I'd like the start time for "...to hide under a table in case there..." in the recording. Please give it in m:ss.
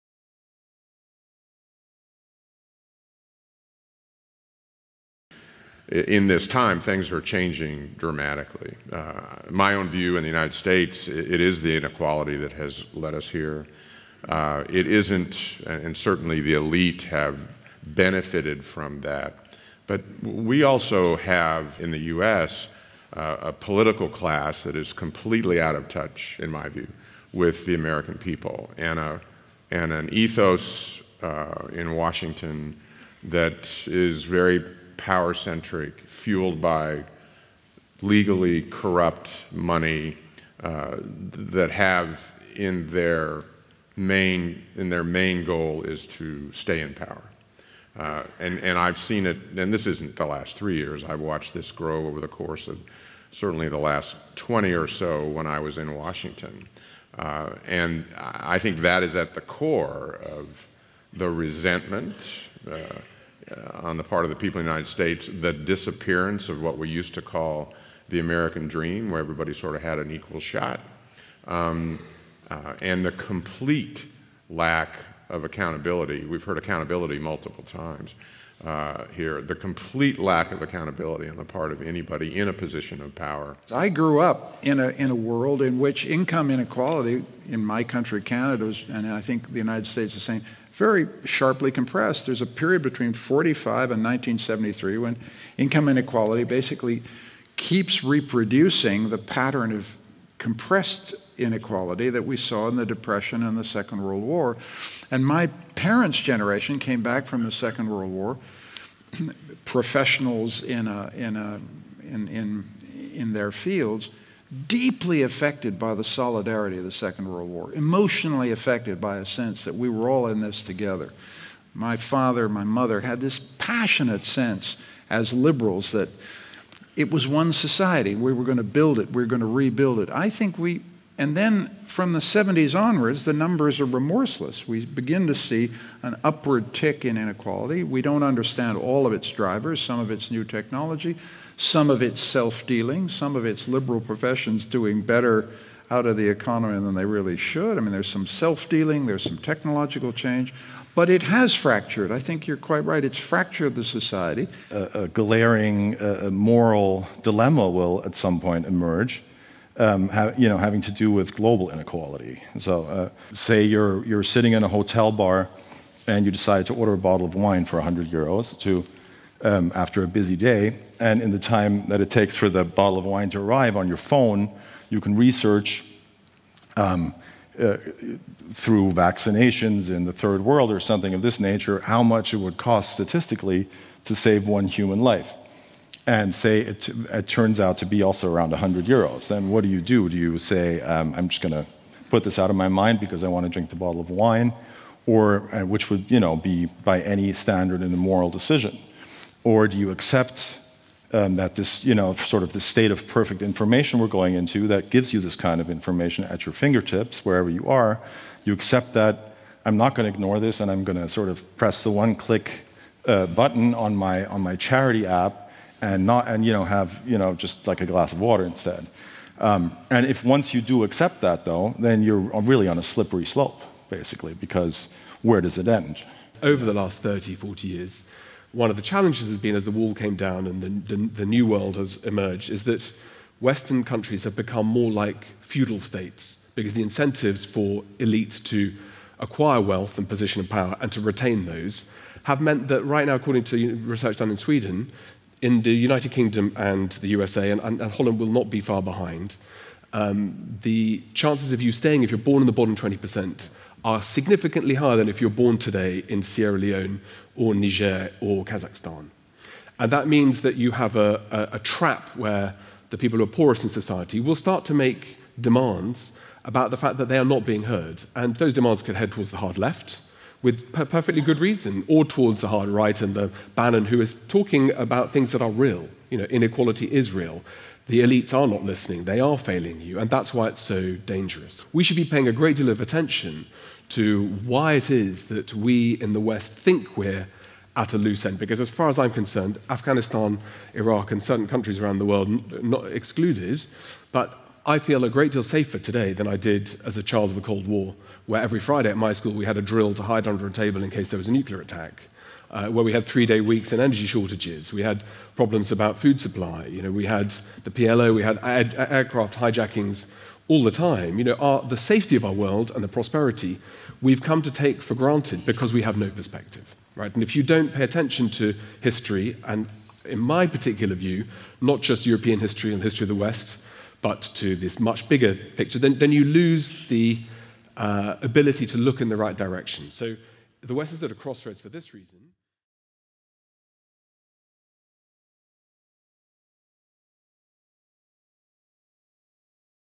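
4:59.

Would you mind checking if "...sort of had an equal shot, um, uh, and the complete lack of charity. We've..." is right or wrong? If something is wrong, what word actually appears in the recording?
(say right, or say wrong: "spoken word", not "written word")
wrong: "accountability", not "charity".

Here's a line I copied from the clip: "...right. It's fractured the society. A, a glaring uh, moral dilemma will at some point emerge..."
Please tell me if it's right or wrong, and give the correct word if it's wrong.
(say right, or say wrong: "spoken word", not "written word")
right.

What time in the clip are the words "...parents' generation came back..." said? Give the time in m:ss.
1:45.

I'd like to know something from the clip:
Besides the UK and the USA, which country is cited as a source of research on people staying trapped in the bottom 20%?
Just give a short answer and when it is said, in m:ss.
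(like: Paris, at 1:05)
Sweden, at 4:04.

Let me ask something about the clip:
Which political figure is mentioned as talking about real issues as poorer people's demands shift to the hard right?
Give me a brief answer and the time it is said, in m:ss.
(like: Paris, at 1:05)
Bannon, at 4:33.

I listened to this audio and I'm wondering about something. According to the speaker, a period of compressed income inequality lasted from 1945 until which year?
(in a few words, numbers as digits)
1973.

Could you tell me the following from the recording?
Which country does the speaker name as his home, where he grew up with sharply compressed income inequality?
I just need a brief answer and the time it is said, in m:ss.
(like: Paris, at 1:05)
Canada, at 1:28.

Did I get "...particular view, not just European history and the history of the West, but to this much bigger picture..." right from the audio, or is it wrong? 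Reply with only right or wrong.
right.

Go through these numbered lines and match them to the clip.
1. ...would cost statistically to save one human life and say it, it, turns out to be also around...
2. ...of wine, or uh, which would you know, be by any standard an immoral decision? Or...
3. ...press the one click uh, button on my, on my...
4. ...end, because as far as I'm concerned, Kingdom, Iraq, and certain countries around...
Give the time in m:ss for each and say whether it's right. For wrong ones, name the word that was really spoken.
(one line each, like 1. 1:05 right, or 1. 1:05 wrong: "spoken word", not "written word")
1. 3:02 right
2. 3:14 right
3. 3:31 right
4. 4:48 wrong: "Afghanistan", not "Kingdom".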